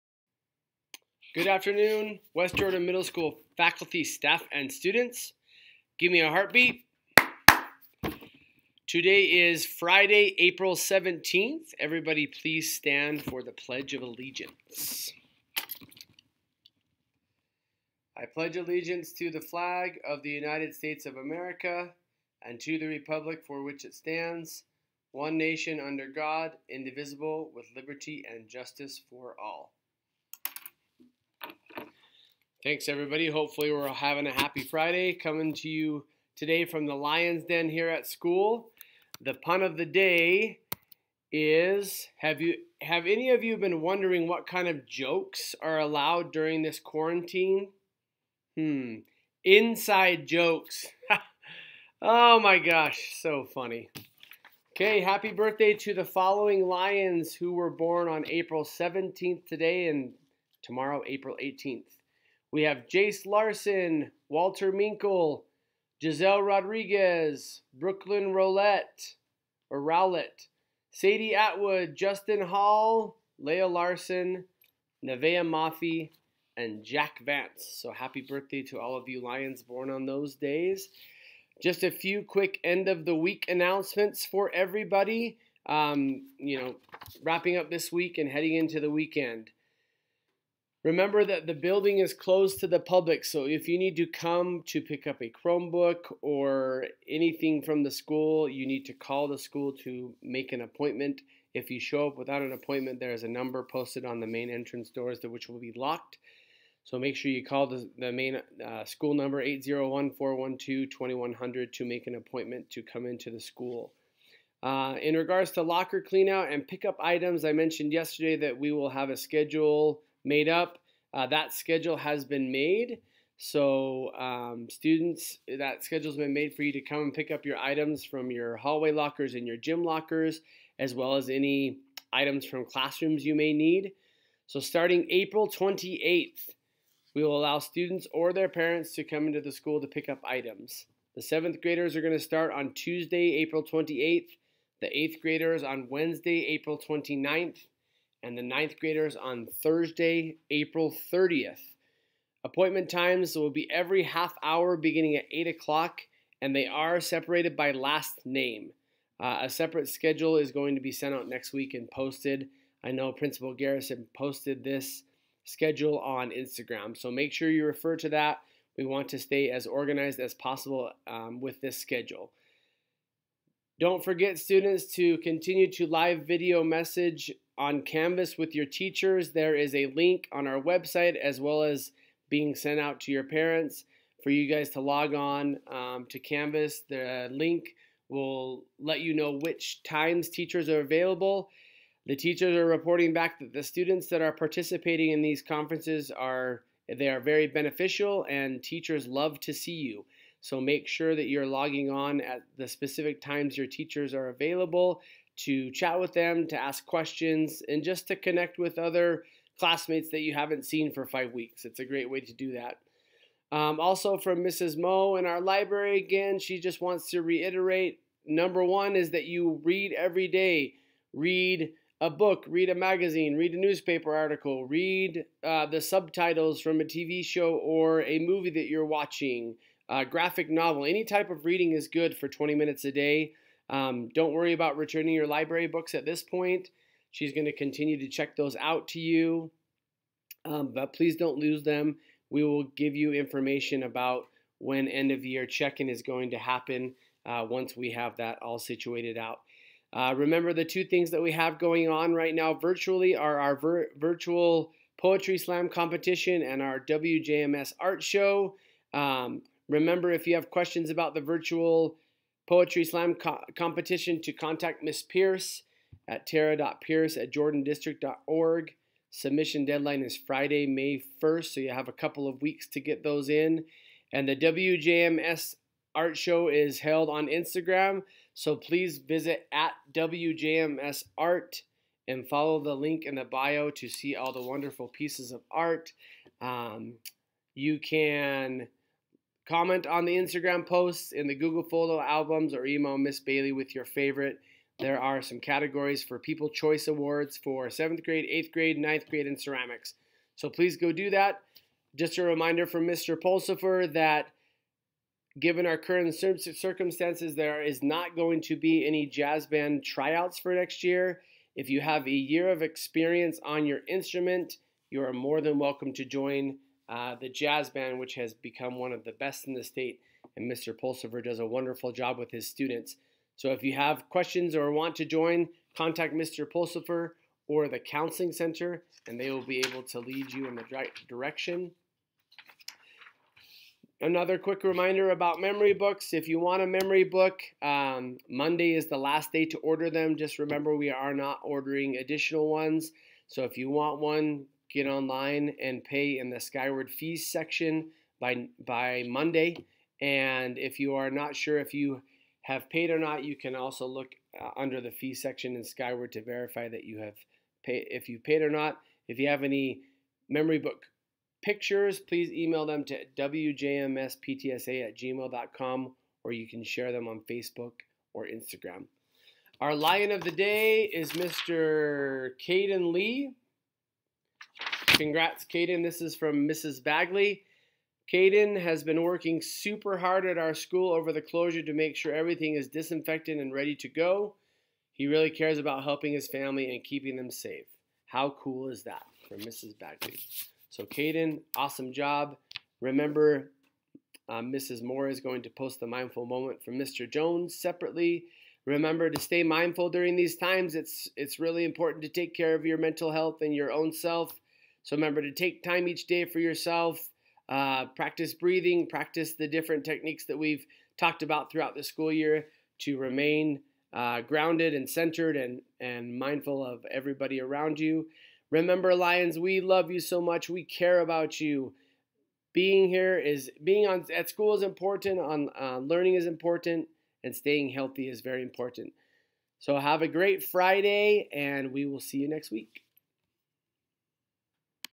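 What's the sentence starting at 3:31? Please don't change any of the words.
It's a great way to do that.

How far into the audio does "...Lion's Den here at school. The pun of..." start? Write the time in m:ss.
0:36.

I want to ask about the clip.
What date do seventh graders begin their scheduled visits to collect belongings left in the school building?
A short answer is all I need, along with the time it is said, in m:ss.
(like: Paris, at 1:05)
April 28th, at 2:22.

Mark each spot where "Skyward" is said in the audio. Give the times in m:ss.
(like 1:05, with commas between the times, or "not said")
5:46, 5:55.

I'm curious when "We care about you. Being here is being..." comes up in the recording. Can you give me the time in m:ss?
7:00.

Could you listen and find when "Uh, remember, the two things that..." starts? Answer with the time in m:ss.
4:09.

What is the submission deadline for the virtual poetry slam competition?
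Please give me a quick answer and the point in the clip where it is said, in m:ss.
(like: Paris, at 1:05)
Friday, May 1st, at 4:30.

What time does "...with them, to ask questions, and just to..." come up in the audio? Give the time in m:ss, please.
3:25.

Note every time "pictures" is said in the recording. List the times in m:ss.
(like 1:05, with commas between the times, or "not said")
6:01.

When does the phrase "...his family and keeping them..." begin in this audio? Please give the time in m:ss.
6:26.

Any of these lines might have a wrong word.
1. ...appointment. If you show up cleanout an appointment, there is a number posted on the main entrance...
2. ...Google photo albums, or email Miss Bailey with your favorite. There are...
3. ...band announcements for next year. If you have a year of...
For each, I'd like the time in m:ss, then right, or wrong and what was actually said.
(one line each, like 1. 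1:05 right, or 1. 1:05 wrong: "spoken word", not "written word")
1. 1:40 wrong: "without", not "cleanout"
2. 4:51 right
3. 5:09 wrong: "tryouts", not "announcements".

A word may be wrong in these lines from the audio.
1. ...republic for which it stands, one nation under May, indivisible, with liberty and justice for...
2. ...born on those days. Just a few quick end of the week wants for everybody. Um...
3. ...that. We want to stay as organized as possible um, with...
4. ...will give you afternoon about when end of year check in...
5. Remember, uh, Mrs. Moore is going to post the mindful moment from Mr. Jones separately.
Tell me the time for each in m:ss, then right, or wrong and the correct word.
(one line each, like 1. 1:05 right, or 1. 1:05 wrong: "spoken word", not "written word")
1. 0:22 wrong: "God", not "May"
2. 1:19 wrong: "announcements", not "wants"
3. 2:48 right
4. 4:02 wrong: "information", not "afternoon"
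5. 6:32 right.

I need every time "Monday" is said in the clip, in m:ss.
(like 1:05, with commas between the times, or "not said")
5:38, 5:49.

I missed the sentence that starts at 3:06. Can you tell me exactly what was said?
The link will let you know which times teachers are available.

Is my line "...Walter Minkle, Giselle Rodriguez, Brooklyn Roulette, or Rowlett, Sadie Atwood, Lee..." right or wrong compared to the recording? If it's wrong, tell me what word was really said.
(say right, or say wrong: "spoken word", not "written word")
wrong: "Justin", not "Lee".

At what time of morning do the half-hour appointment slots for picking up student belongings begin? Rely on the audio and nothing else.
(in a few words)
8 o'clock.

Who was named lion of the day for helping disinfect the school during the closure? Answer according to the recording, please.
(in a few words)
Caden Lee.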